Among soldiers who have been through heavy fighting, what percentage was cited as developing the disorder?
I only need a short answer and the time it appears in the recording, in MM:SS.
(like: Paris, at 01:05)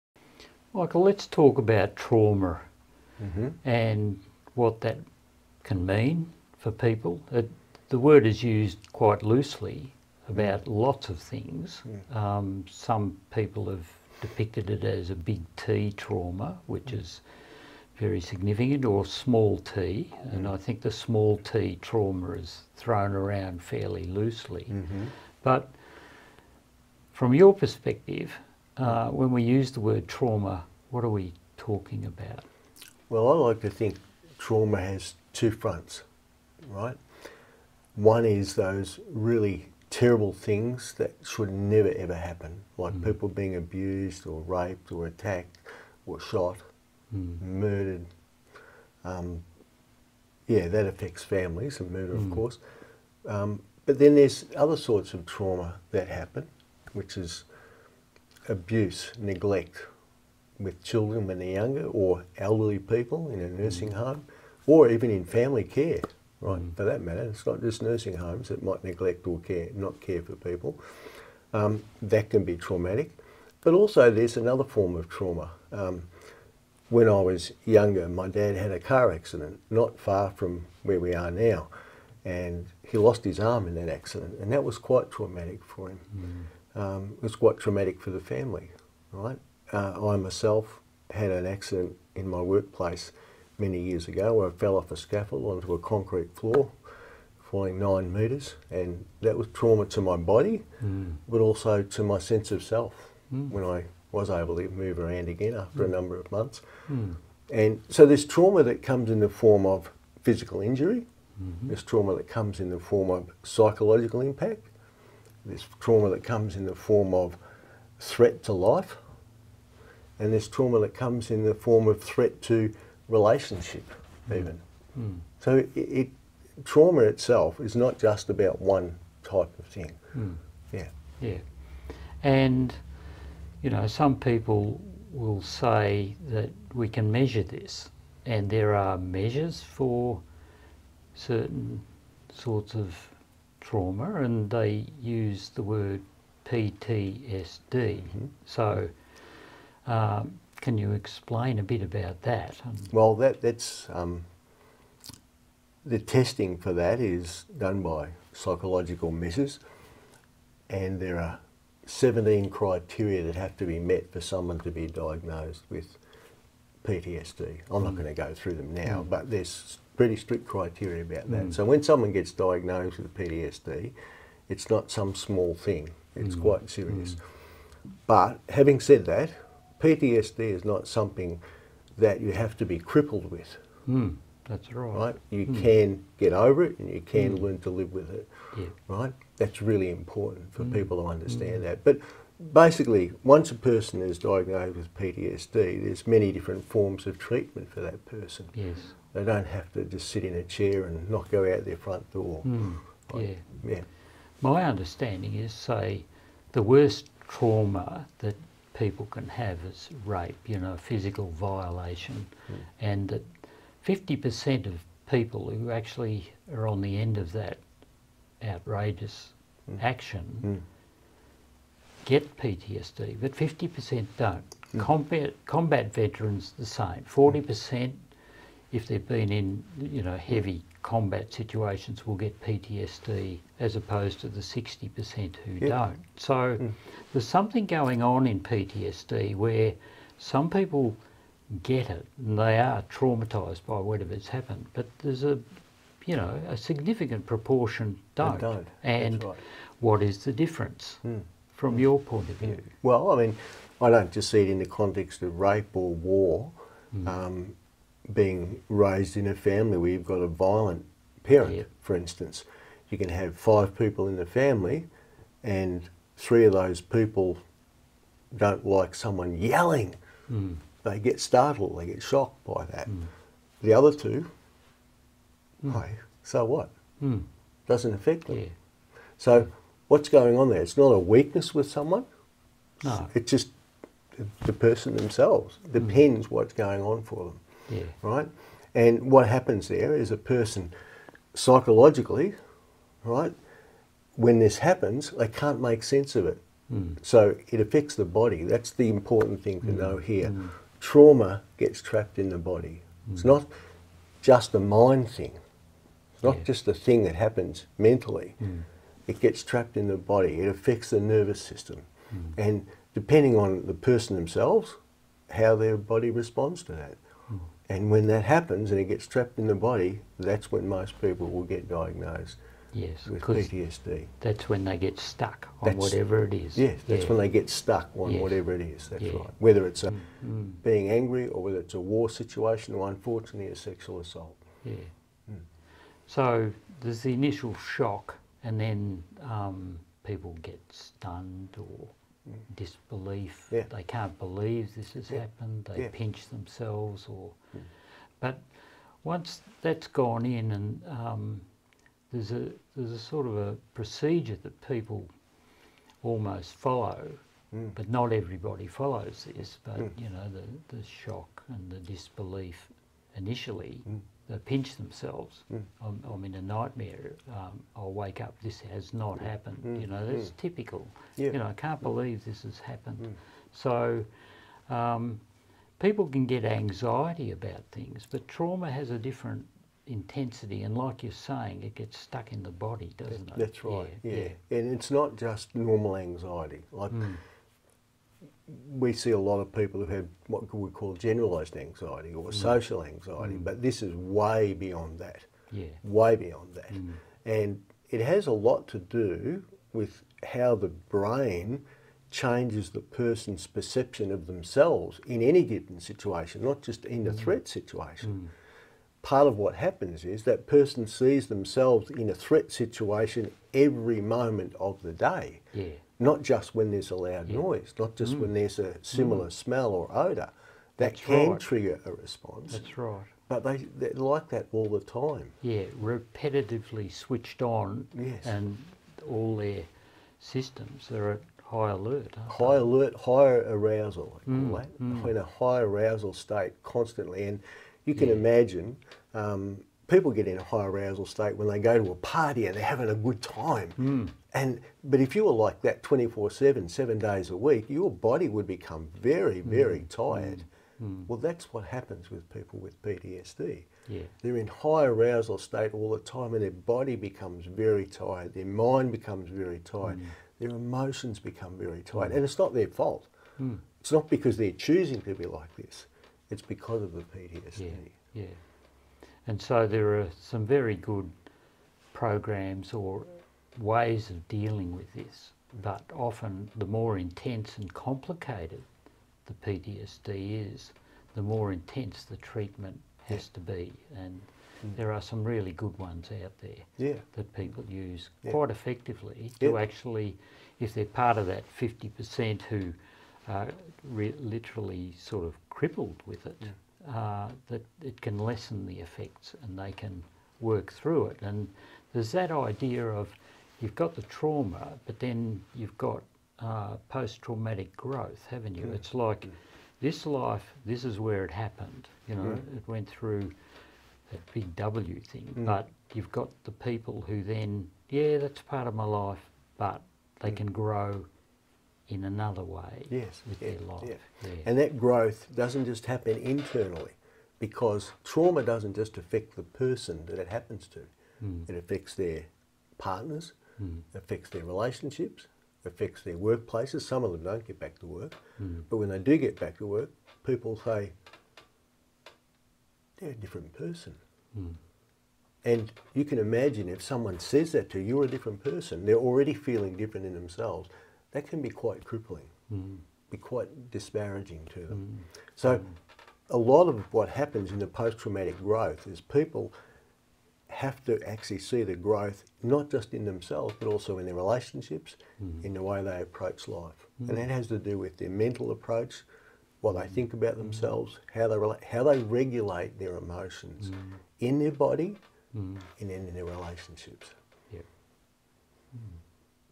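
40%, at 03:47.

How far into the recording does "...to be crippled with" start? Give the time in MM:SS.
03:02.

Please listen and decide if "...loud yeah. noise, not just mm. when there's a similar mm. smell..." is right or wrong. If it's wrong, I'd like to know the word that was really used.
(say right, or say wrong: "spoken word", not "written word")
right.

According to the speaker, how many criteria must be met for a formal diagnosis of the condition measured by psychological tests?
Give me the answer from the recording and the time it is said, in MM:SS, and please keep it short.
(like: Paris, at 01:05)
17, at 02:41.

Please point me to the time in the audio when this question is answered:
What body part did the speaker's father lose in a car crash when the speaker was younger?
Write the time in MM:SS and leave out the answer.
01:23.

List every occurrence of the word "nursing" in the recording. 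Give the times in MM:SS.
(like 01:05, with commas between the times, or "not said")
01:03, 01:07.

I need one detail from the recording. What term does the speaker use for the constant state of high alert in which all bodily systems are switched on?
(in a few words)
higher arousal.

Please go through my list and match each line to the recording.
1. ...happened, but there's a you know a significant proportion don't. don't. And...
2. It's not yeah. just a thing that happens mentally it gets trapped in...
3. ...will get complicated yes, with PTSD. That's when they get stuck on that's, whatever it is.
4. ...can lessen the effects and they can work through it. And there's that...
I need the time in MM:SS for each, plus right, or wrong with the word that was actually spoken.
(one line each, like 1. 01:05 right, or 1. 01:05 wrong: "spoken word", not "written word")
1. 04:04 right
2. 05:06 right
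3. 05:21 wrong: "diagnosed", not "complicated"
4. 08:18 right.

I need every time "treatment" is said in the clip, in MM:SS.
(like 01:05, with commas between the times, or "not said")
03:17, 08:02.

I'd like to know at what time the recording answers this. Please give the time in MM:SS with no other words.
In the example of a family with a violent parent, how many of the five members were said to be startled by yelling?
04:26.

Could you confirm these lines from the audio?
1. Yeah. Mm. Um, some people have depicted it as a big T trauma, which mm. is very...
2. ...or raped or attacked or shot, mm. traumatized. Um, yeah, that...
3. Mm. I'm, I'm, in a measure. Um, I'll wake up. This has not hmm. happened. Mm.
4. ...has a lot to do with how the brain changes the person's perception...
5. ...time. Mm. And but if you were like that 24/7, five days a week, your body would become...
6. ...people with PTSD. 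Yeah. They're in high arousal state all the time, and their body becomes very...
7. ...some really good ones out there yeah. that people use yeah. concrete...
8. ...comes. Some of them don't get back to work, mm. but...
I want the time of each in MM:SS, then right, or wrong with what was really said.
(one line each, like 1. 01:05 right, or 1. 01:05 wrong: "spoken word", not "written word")
1. 00:11 right
2. 00:44 wrong: "murdered", not "traumatized"
3. 06:05 wrong: "nightmare", not "measure"
4. 06:38 right
5. 07:23 wrong: "seven", not "five"
6. 07:32 right
7. 08:05 wrong: "quite", not "concrete"
8. 08:56 wrong: "workplaces", not "comes".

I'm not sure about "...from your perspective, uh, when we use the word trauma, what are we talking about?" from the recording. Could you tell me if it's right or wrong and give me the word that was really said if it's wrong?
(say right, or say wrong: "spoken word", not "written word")
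right.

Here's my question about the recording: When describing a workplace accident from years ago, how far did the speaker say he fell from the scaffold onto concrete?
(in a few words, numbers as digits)
9 metres.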